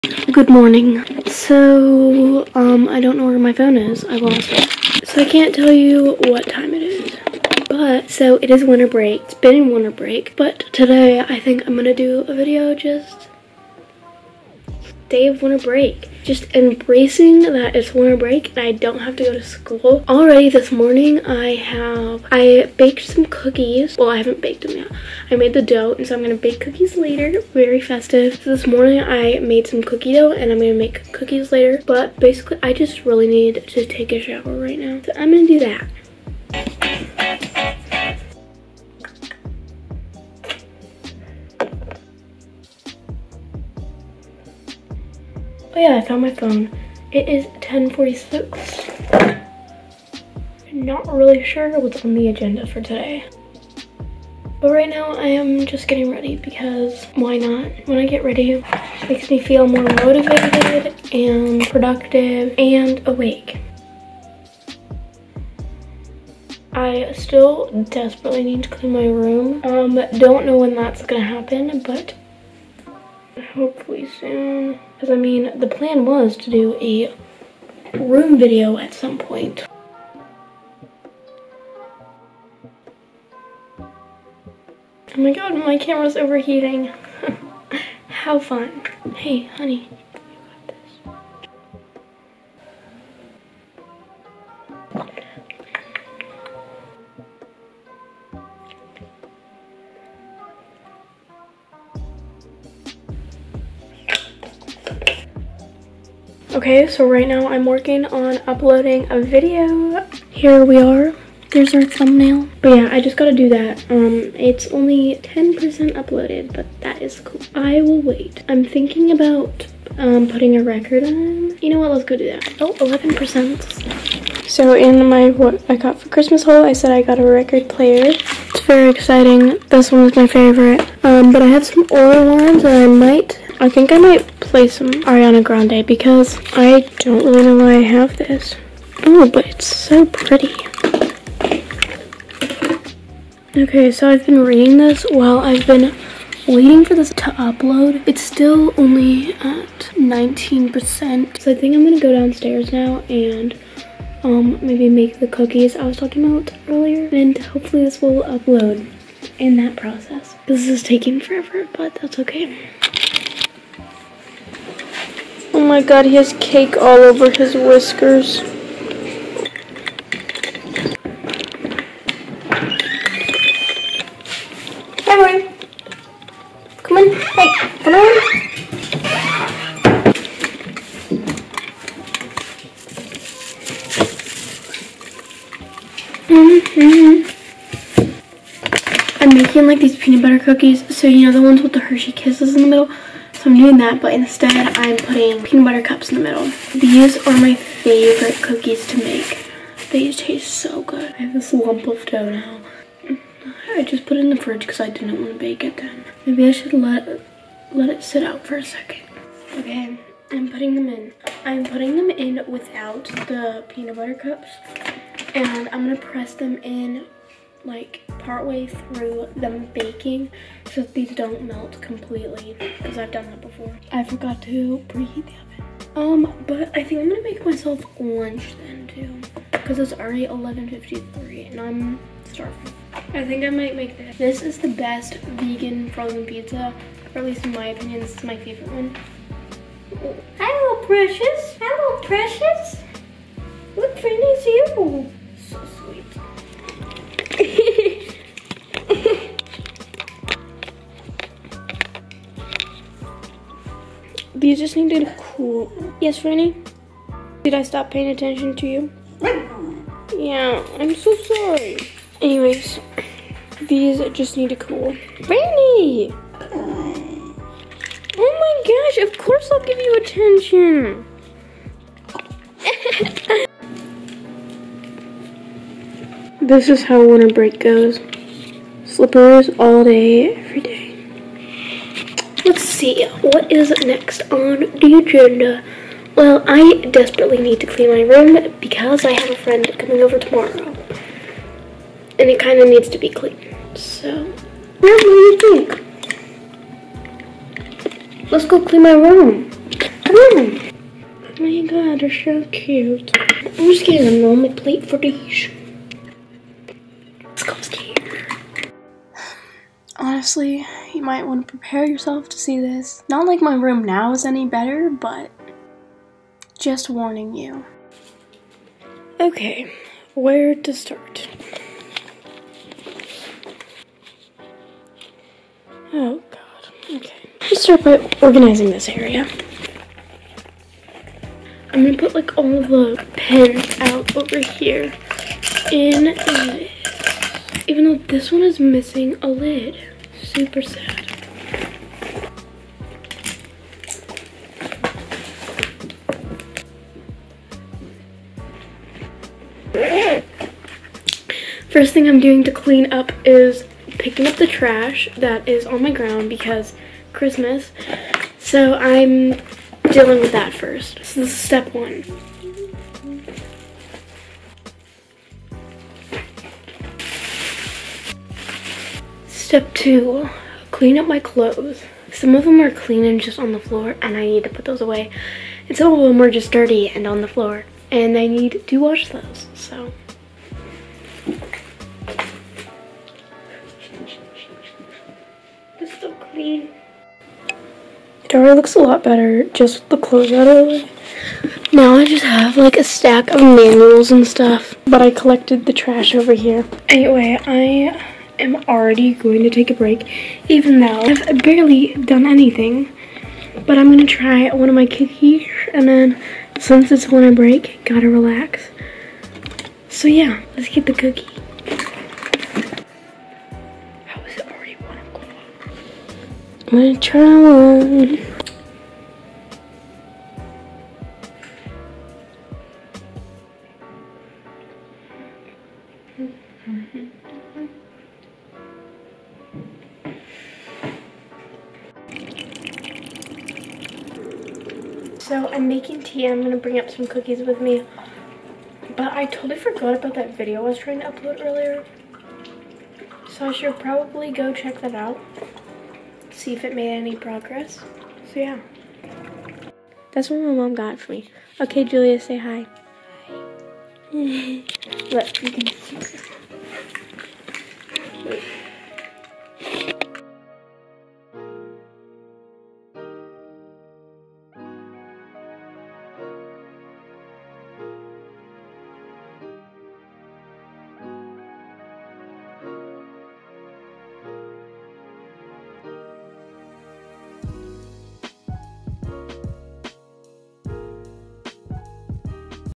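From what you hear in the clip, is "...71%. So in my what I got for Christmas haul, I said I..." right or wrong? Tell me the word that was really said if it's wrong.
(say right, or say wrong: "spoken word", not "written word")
wrong: "11", not "71".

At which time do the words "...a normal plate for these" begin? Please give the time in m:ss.
5:04.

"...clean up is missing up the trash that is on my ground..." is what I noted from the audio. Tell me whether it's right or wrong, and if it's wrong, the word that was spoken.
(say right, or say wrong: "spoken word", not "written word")
wrong: "picking", not "missing".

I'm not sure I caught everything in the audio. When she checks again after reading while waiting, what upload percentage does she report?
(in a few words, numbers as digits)
19%.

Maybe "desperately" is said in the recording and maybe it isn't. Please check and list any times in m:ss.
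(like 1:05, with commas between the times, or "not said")
1:07, 4:46.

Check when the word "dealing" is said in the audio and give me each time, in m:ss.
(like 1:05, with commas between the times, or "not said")
5:59.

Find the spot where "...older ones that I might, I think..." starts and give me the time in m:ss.
2:11.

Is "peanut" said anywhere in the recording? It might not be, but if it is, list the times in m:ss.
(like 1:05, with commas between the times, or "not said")
3:09, 3:15, 3:33.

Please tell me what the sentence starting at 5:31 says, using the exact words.
I'm gonna put like all the pens out over here in this.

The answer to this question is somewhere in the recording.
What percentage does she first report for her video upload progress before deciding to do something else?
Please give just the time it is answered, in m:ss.
1:55.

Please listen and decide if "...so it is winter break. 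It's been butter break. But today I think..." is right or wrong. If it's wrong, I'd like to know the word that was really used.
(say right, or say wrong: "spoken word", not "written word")
wrong: "winter", not "butter".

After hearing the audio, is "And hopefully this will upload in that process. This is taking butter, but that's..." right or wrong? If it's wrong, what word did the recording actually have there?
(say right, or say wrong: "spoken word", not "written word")
wrong: "forever", not "butter".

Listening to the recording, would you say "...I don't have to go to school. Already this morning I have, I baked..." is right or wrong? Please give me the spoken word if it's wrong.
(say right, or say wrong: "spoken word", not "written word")
right.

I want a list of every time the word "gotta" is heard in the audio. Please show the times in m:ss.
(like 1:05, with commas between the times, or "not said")
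1:53, 6:47.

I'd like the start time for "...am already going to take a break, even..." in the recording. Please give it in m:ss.
6:38.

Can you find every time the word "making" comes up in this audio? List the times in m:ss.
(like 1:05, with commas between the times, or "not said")
3:09, 7:15.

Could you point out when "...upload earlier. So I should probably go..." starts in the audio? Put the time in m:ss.
7:21.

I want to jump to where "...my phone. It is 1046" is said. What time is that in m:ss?
0:46.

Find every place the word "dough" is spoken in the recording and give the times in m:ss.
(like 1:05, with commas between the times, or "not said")
0:25, 0:30, 3:22.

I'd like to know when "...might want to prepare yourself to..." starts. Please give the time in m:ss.
5:11.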